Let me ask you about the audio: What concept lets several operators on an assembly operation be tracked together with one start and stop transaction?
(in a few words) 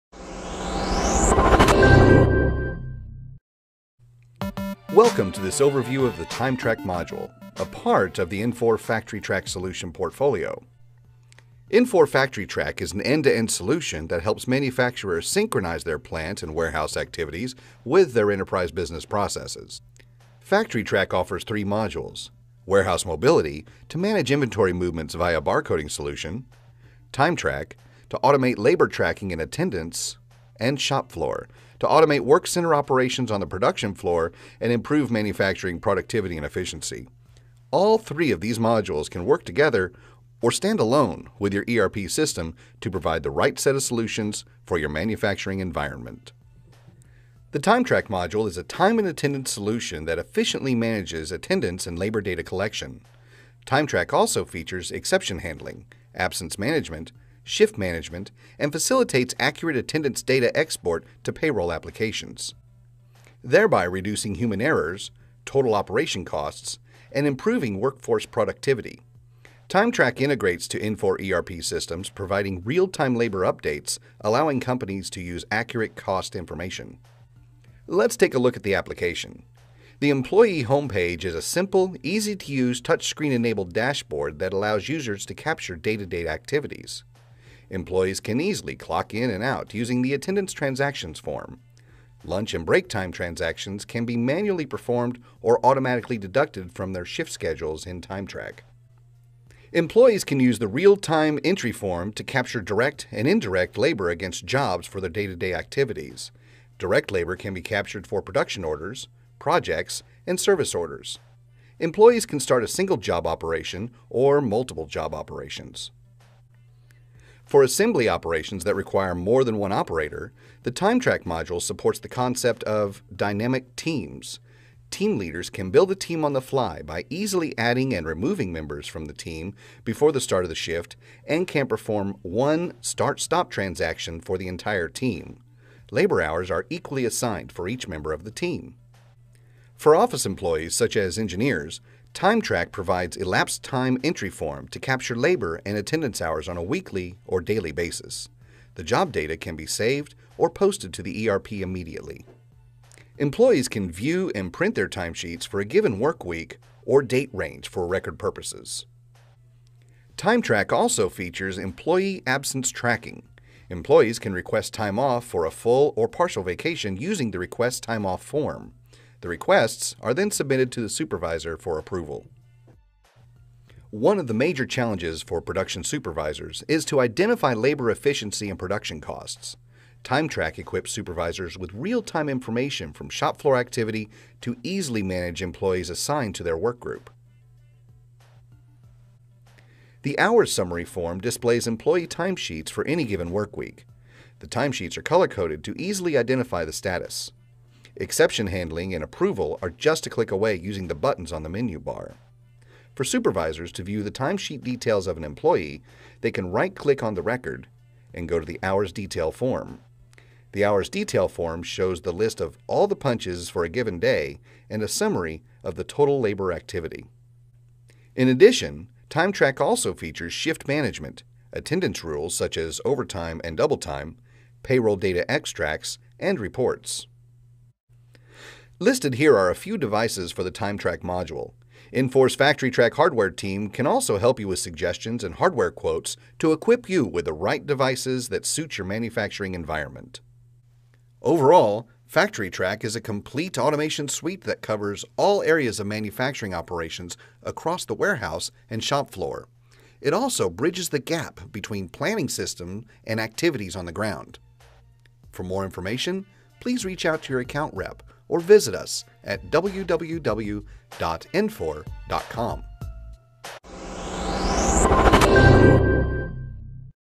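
dynamic teams.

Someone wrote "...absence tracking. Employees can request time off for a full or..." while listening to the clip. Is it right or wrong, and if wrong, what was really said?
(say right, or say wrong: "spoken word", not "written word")
right.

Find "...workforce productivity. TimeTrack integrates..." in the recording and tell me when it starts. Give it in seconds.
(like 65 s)
67 s.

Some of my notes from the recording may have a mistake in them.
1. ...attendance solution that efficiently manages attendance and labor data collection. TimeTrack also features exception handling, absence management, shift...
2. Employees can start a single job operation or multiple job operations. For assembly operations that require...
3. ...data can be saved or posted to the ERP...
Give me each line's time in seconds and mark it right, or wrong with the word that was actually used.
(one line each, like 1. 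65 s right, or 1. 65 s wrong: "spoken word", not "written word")
1. 49 s right
2. 111 s right
3. 149 s right.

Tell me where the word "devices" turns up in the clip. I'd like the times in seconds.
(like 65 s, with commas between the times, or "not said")
229 s, 237 s.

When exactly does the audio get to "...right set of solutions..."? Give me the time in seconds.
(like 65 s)
43 s.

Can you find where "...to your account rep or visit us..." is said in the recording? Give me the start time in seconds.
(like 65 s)
257 s.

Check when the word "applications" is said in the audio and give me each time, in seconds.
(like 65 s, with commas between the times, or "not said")
61 s, 78 s.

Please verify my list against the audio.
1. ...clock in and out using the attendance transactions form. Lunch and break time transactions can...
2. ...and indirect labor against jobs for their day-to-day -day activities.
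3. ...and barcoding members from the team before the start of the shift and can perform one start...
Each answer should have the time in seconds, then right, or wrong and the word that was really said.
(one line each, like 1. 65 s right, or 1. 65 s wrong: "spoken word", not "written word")
1. 88 s right
2. 103 s right
3. 127 s wrong: "removing", not "barcoding".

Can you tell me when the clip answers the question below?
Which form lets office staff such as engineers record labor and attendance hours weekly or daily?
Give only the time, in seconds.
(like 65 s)
143 s.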